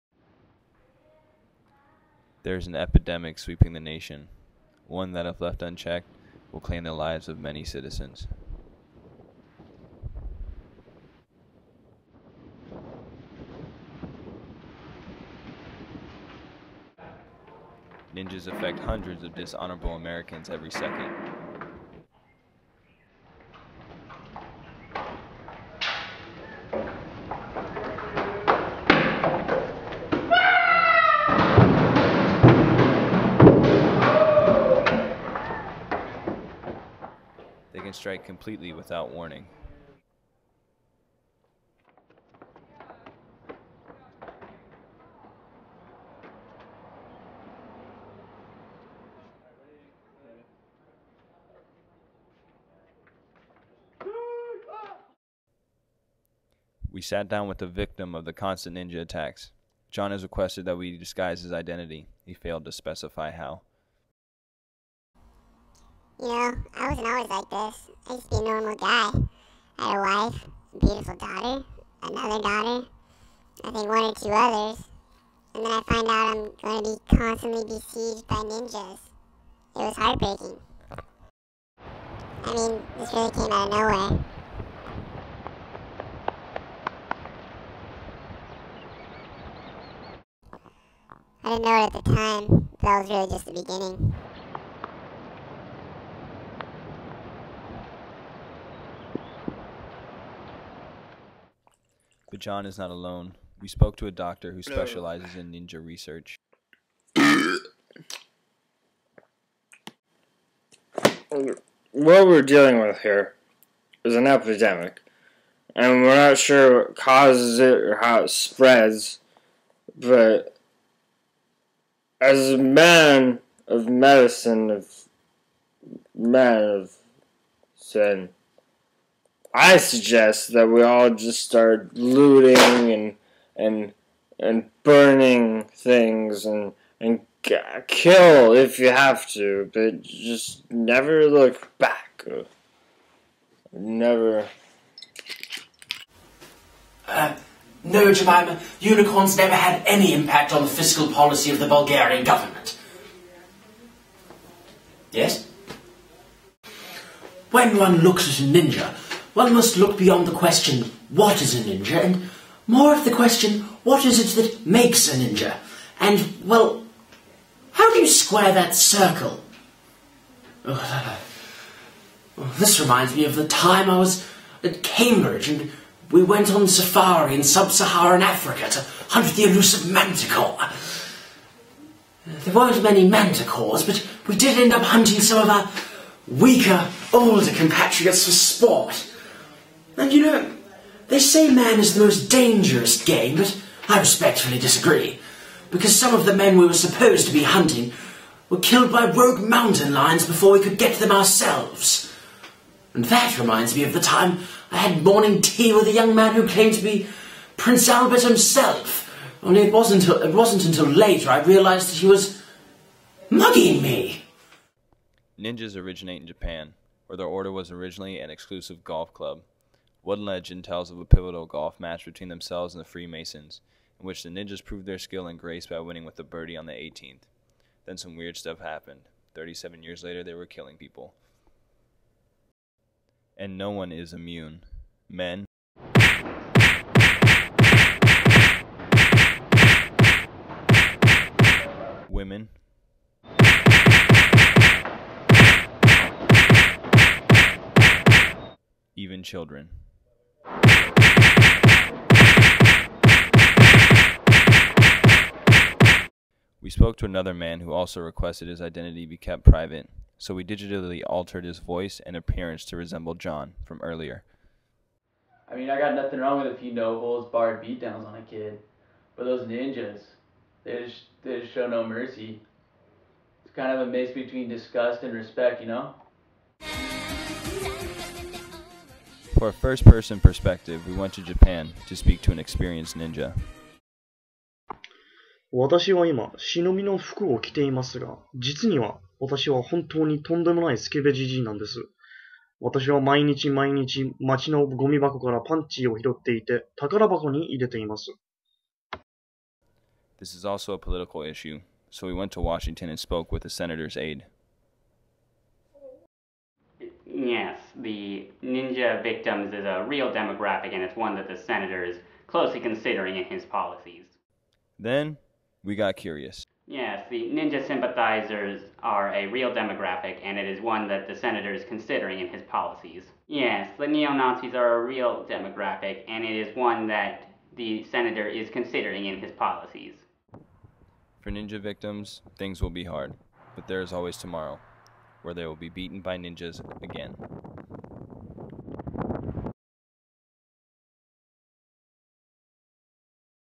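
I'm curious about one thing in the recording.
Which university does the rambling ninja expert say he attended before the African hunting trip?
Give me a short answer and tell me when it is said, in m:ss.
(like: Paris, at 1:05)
Cambridge, at 2:54.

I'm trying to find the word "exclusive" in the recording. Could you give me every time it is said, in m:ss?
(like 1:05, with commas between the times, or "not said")
3:38.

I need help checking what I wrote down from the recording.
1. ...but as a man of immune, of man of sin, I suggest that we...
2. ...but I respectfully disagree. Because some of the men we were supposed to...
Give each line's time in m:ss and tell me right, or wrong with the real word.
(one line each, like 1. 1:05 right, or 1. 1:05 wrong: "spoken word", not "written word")
1. 1:59 wrong: "medicine", not "immune"
2. 3:13 right.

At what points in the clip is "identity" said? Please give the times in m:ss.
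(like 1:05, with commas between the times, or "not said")
1:01, 4:18.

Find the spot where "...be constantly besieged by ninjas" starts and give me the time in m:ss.
1:17.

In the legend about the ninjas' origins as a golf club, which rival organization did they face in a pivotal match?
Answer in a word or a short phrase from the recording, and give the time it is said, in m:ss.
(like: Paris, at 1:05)
the Freemasons, at 3:42.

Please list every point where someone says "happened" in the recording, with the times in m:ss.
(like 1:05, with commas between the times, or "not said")
3:48.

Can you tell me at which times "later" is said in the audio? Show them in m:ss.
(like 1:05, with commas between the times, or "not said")
3:30, 3:50.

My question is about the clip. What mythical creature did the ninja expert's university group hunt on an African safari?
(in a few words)
manticore.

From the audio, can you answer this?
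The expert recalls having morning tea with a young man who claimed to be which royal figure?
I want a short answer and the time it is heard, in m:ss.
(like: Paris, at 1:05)
Prince Albert, at 3:27.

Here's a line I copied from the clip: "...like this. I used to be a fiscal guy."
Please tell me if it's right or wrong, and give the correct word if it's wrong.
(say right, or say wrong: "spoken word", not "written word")
wrong: "normal", not "fiscal".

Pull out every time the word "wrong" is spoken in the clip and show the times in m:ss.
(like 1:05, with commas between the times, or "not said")
4:26.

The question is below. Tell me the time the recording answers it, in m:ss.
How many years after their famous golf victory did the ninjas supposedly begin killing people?
3:49.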